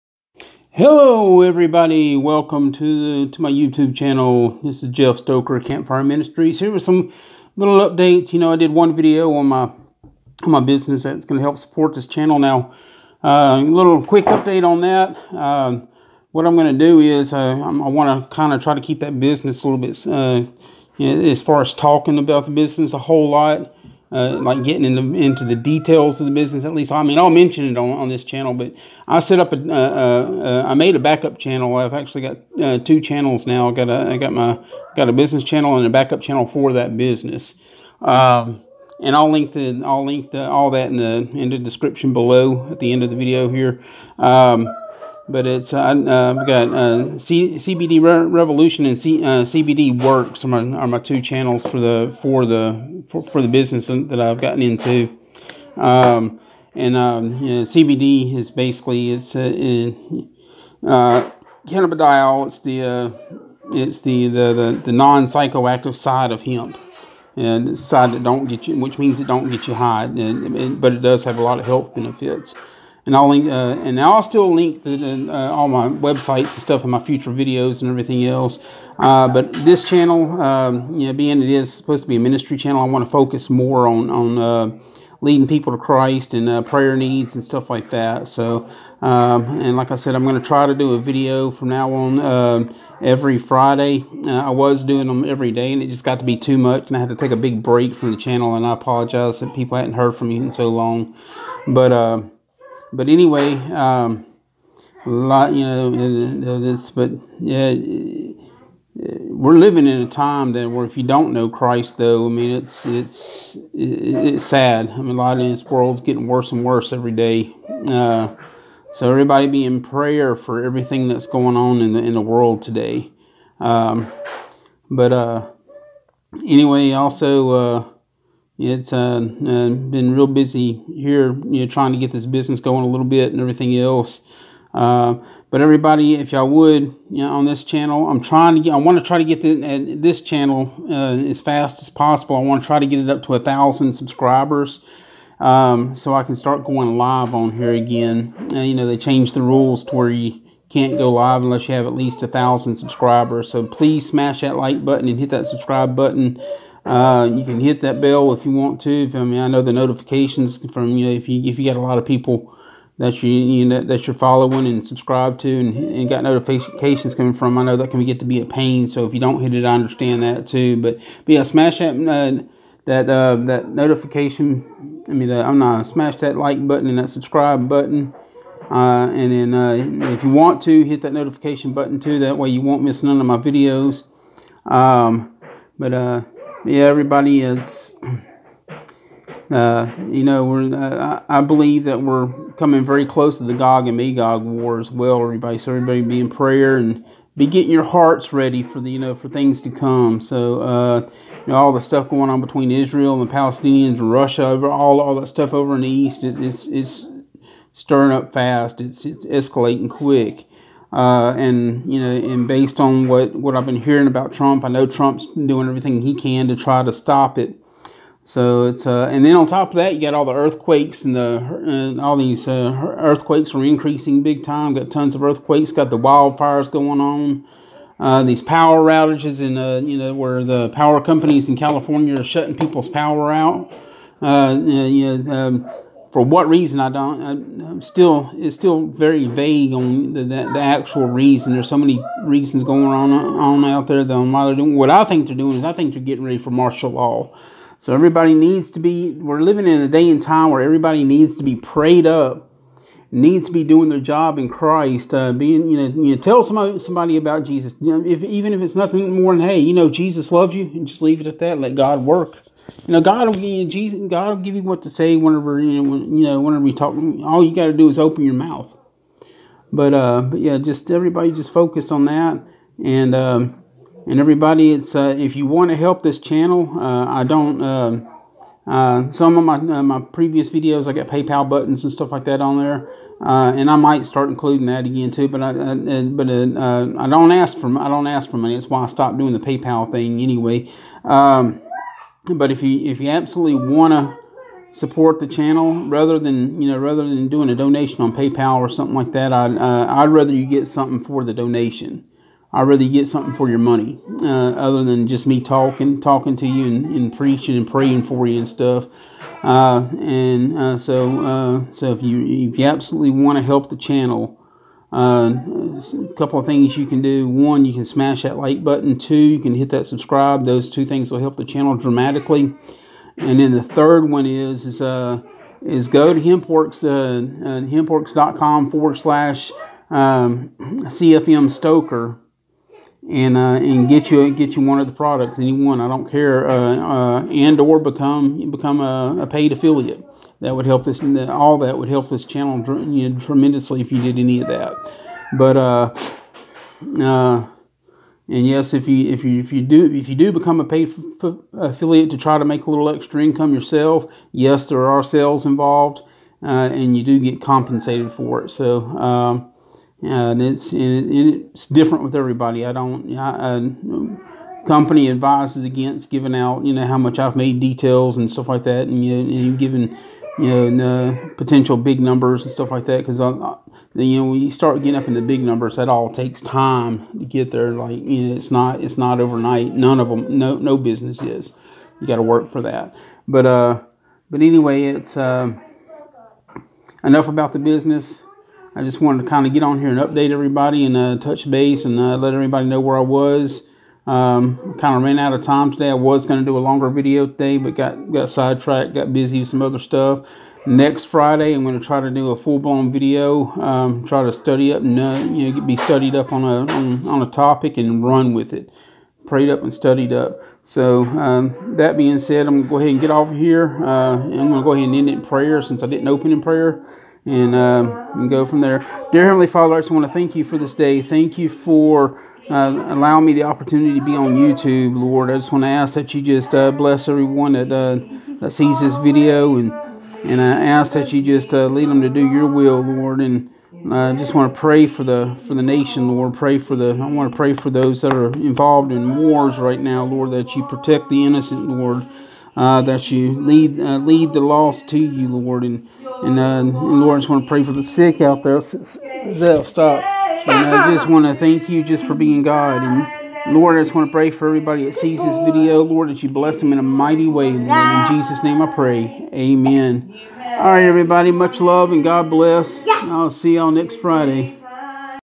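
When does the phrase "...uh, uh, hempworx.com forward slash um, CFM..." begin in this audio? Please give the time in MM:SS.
05:26.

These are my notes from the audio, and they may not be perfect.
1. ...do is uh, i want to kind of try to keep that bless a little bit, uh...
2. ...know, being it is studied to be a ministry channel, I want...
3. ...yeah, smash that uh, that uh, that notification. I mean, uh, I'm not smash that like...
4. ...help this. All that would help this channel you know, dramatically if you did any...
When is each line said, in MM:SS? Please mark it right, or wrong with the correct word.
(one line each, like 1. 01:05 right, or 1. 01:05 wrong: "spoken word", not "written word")
1. 00:16 wrong: "business", not "bless"
2. 01:21 wrong: "supposed", not "studied"
3. 02:51 right
4. 05:40 wrong: "tremendously", not "dramatically".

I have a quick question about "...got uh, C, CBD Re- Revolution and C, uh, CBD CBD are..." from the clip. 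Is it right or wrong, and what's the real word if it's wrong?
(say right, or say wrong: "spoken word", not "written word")
wrong: "Works", not "CBD".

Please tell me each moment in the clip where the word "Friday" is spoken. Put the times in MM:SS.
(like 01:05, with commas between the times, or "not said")
01:33, 06:41, 07:43.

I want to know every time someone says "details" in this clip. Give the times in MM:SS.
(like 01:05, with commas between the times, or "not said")
00:25, 06:07.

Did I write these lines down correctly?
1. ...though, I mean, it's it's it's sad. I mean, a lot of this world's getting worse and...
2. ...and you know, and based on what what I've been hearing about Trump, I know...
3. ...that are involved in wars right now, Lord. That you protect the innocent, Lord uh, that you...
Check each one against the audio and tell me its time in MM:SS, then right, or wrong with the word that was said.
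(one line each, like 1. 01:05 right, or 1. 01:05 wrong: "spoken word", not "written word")
1. 01:51 right
2. 03:31 right
3. 07:18 right.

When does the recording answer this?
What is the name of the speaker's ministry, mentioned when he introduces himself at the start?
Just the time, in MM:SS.
00:05.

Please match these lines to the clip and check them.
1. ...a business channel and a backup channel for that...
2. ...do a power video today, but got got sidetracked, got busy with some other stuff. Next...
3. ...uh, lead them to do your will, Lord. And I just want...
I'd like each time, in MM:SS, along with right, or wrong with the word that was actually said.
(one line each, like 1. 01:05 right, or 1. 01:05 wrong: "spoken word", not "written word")
1. 00:35 right
2. 06:36 wrong: "longer", not "power"
3. 07:11 right.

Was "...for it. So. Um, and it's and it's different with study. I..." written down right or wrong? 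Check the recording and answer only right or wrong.
wrong.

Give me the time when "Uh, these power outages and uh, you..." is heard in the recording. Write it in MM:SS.
03:47.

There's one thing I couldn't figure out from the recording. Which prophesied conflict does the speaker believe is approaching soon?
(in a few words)
Gog and Magog war.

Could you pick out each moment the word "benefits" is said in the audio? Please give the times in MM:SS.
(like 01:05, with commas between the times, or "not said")
01:11.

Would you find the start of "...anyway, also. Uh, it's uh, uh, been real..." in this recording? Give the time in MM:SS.
02:06.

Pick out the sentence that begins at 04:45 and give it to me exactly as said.
But I, I but uh, uh, I don't ask for I don't ask for money.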